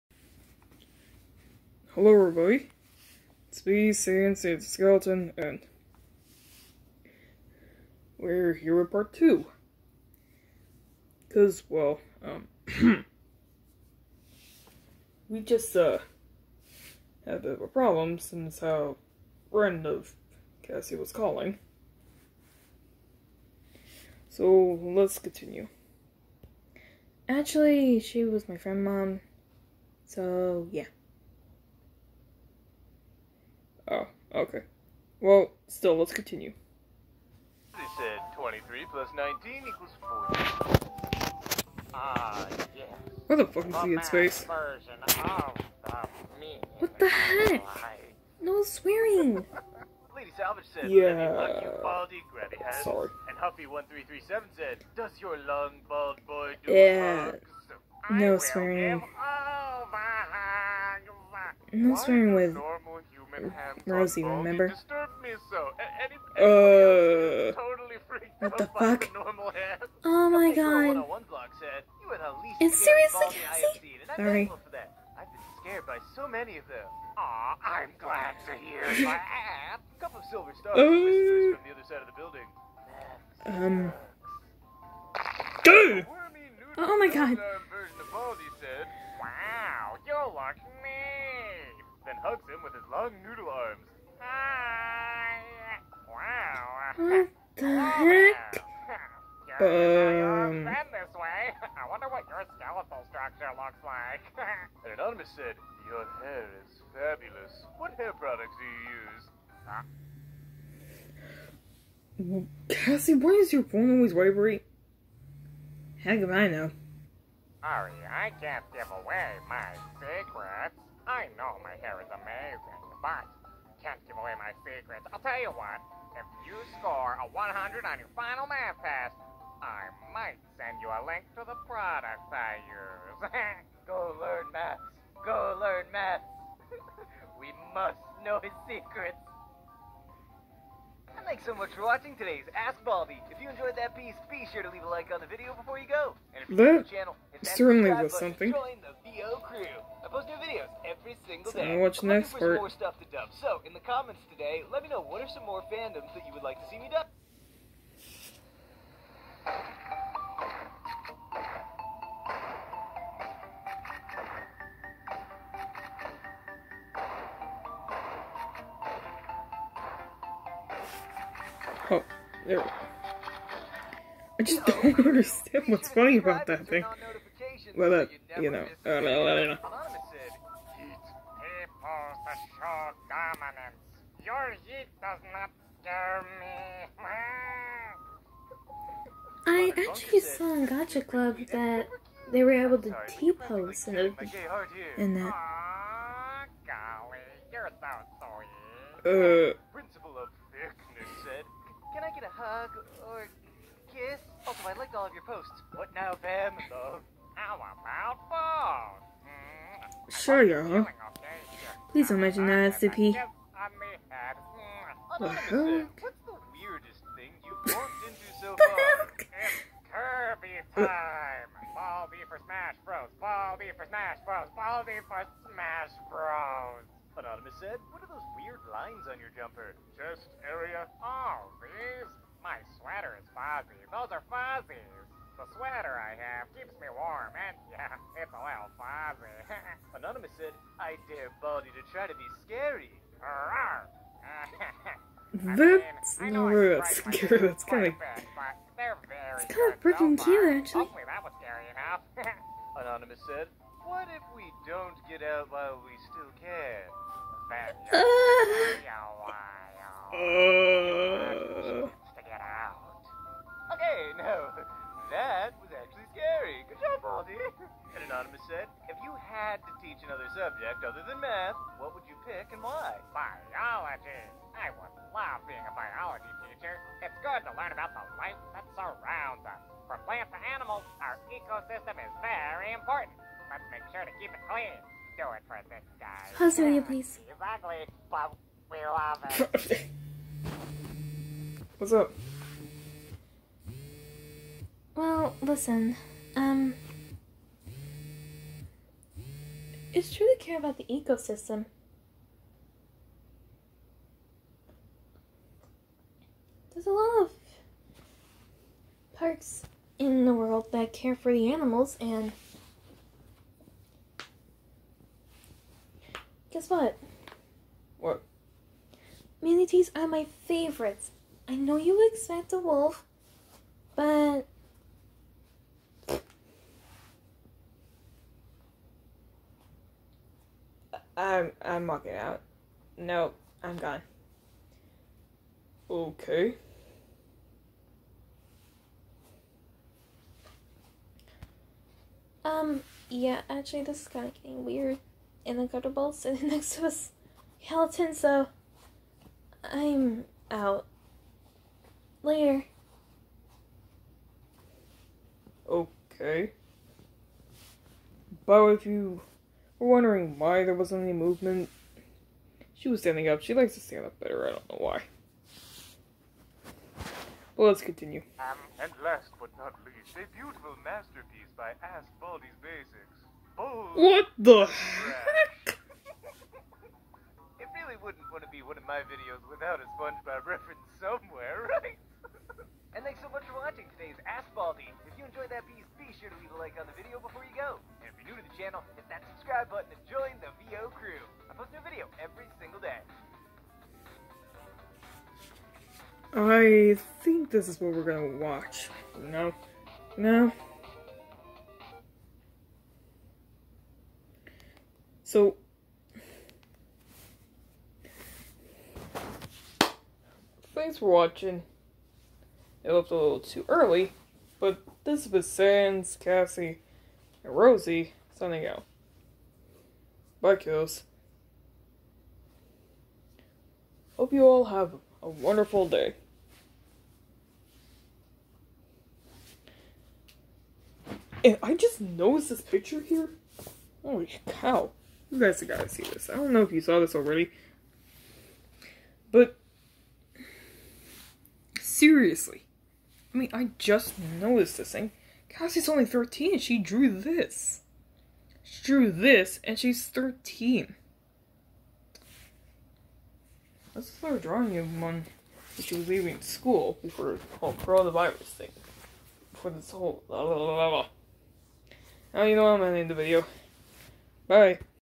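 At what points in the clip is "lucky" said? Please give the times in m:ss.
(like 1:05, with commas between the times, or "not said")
0:51, 1:30.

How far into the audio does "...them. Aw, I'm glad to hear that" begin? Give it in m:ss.
1:16.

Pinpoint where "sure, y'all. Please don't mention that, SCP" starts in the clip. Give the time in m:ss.
3:30.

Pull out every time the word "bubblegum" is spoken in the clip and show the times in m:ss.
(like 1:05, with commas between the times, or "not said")
not said.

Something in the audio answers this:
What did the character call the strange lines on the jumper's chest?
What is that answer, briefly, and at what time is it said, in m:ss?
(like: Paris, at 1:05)
fuzzies, at 3:53.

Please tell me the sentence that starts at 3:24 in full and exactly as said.
Also, oh, I liked all of your posts.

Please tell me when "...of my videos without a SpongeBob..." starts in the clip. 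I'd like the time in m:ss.
6:18.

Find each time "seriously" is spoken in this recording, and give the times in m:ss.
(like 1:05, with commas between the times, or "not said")
1:12, 7:22.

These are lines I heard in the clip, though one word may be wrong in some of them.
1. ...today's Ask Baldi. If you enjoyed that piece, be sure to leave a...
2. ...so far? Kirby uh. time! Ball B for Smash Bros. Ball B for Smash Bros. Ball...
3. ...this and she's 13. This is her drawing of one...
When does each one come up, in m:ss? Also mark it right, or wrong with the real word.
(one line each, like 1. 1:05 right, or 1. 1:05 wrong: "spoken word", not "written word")
1. 2:22 right
2. 3:38 right
3. 7:29 right.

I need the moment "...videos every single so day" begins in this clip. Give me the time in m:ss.
2:30.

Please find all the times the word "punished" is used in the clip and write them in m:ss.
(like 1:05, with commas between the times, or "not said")
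not said.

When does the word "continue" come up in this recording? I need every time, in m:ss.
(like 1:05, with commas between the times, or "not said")
0:25, 0:36, 6:07.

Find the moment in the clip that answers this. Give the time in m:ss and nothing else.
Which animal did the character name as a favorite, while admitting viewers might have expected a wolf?
5:19.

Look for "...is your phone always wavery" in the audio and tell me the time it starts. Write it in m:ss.
1:53.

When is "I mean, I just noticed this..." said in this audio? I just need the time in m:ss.
7:23.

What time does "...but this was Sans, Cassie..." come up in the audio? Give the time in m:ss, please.
6:54.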